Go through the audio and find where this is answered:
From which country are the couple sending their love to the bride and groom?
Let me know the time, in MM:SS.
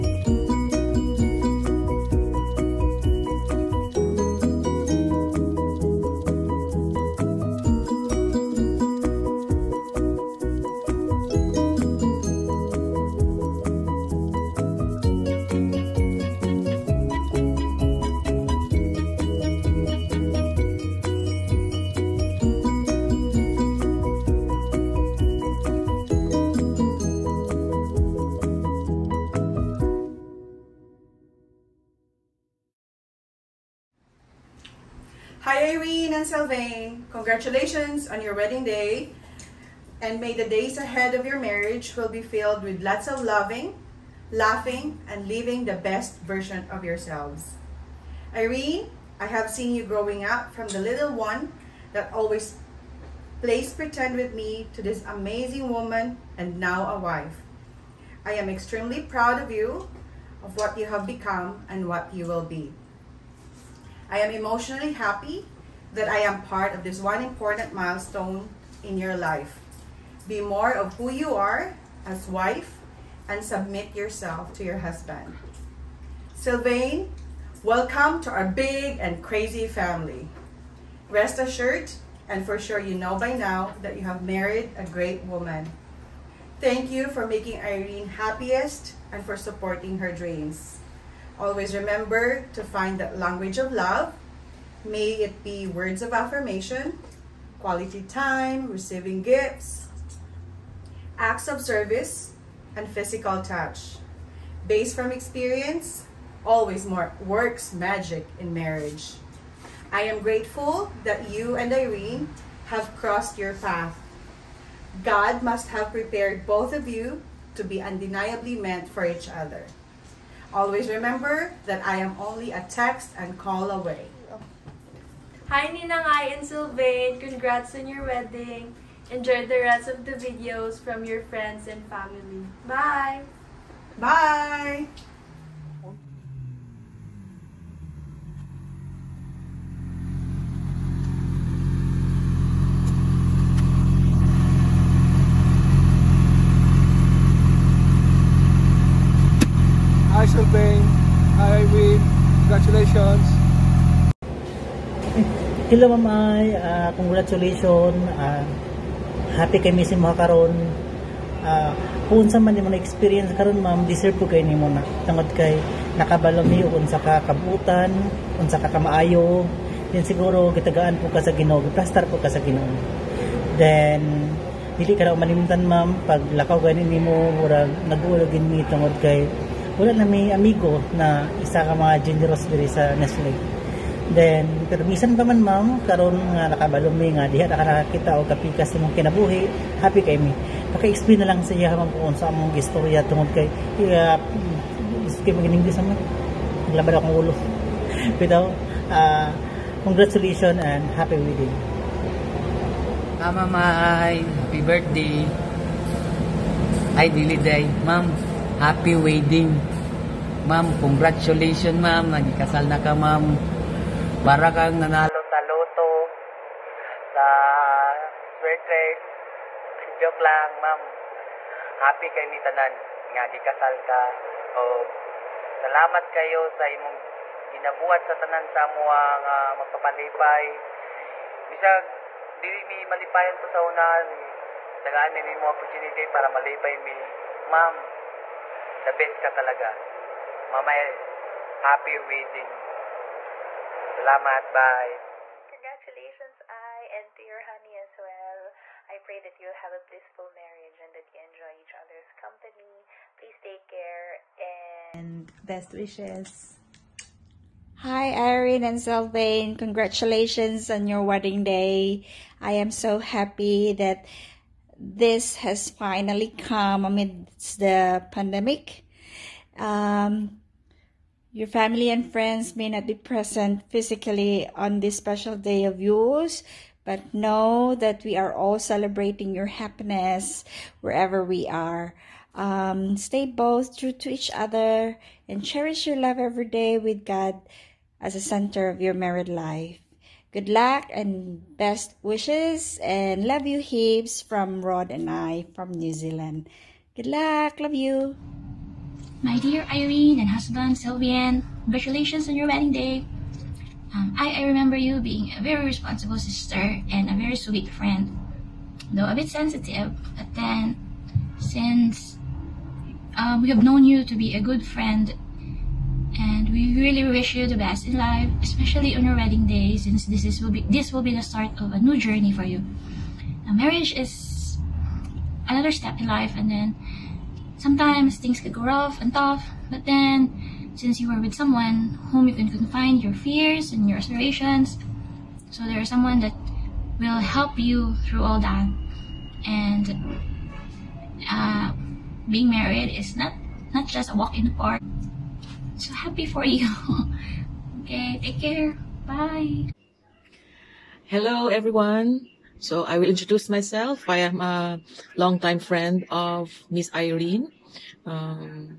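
04:55.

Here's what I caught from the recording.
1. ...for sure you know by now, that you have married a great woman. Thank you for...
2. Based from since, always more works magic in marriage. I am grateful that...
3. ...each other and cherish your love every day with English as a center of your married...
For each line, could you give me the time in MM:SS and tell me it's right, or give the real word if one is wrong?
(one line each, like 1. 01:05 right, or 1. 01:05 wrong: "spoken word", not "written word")
1. 01:22 right
2. 01:44 wrong: "experience", not "since"
3. 04:44 wrong: "God", not "English".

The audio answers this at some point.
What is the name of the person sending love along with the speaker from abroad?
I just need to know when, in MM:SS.
04:54.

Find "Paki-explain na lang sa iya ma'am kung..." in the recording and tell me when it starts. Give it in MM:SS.
03:10.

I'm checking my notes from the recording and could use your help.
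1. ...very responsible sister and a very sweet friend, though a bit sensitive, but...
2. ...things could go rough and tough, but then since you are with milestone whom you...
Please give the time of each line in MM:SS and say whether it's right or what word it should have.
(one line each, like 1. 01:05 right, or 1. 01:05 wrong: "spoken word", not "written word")
1. 05:05 right
2. 05:28 wrong: "someone", not "milestone".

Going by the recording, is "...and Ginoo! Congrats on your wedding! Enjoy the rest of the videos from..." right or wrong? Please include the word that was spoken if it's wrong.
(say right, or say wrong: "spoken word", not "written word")
wrong: "Sylvain", not "Ginoo".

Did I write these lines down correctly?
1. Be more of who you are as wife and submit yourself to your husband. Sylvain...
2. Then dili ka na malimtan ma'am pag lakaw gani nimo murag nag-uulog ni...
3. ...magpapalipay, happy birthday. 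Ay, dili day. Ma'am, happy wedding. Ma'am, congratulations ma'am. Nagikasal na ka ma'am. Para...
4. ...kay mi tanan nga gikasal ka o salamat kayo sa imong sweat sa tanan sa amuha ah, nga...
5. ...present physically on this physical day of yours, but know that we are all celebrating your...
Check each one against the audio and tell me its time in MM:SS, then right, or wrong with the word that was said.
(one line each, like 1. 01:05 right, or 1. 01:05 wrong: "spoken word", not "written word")
1. 01:10 right
2. 02:53 right
3. 03:23 wrong: "mamay", not "magpapalipay"
4. 03:42 wrong: "ginabuhat", not "sweat"
5. 04:32 wrong: "special", not "physical".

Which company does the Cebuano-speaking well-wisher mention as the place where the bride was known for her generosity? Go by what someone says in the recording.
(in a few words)
Nestle.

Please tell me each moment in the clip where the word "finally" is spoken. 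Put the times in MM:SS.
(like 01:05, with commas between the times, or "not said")
04:25.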